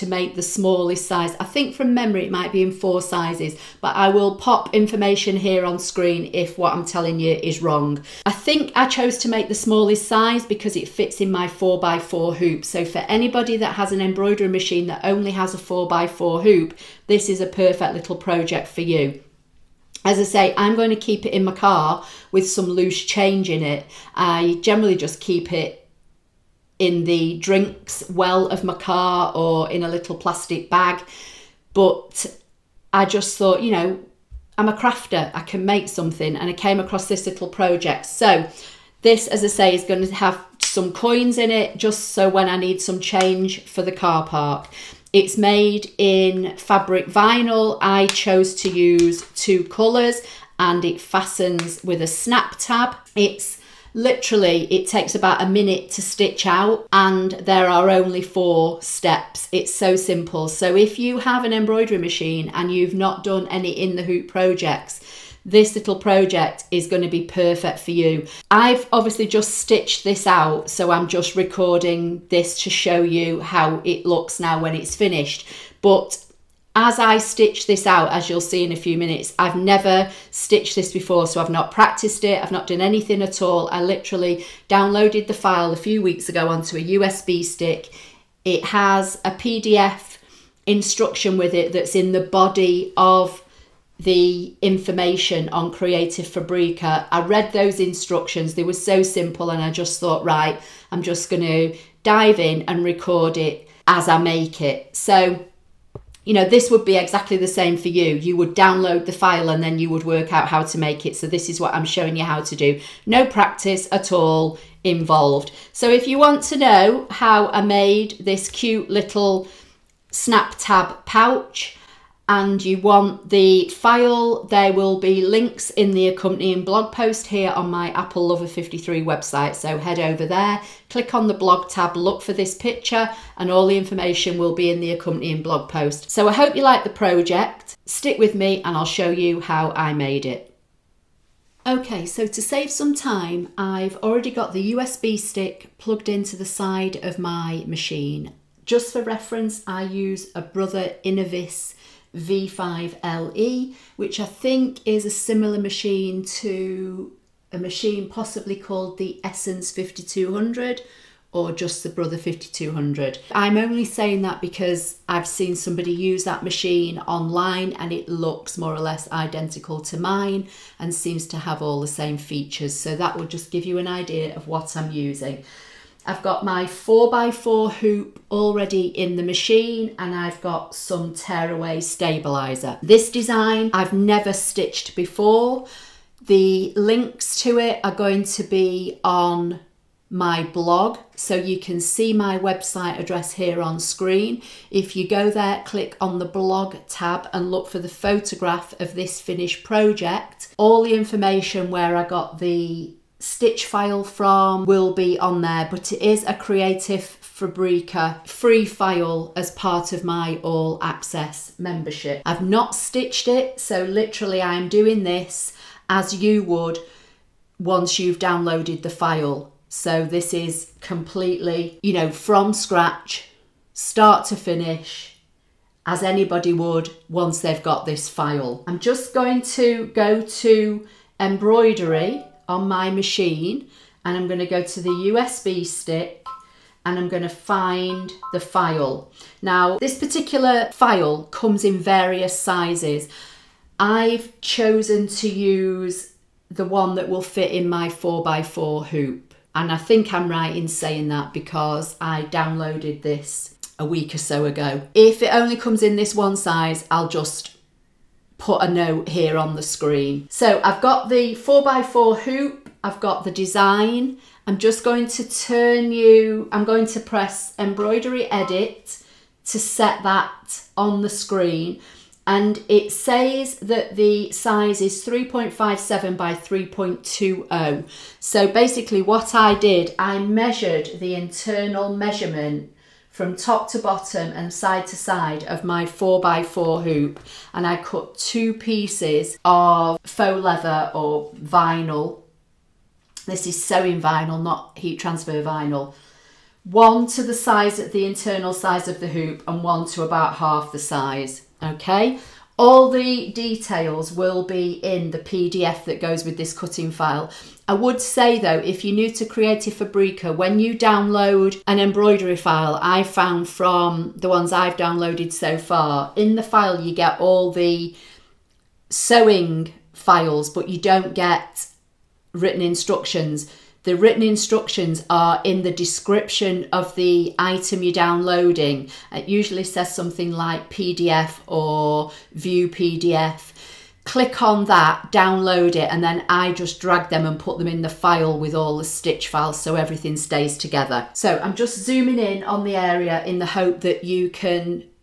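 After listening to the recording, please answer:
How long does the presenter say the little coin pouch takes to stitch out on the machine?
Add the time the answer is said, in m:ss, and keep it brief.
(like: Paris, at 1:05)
about a minute, at 0:55.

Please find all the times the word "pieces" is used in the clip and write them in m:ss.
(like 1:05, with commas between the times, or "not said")
4:48.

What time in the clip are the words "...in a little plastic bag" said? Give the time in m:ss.
0:29.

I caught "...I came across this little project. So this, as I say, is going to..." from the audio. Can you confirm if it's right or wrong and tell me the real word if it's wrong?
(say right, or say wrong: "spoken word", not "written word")
right.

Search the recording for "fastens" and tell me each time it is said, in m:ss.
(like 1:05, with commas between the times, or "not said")
0:51.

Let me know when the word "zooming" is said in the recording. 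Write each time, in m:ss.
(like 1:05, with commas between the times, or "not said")
5:41.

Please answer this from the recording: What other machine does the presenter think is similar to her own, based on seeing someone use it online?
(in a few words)
Essence 5200.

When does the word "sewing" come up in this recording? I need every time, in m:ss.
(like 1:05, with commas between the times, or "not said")
4:53, 5:18.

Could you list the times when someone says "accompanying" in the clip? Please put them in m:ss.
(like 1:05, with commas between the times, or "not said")
2:06, 2:14.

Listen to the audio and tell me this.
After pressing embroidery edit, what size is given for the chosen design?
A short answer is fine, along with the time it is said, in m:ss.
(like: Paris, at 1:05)
3.57 by 3.20, at 4:35.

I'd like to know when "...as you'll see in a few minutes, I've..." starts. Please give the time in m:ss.
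1:18.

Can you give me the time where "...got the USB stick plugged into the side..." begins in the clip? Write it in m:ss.
2:24.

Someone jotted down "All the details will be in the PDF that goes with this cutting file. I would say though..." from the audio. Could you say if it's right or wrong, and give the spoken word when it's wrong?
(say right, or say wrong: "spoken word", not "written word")
right.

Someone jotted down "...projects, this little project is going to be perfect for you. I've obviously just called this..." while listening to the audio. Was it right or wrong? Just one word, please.
wrong.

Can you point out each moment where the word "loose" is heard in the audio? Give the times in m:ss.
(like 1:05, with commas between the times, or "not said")
0:22.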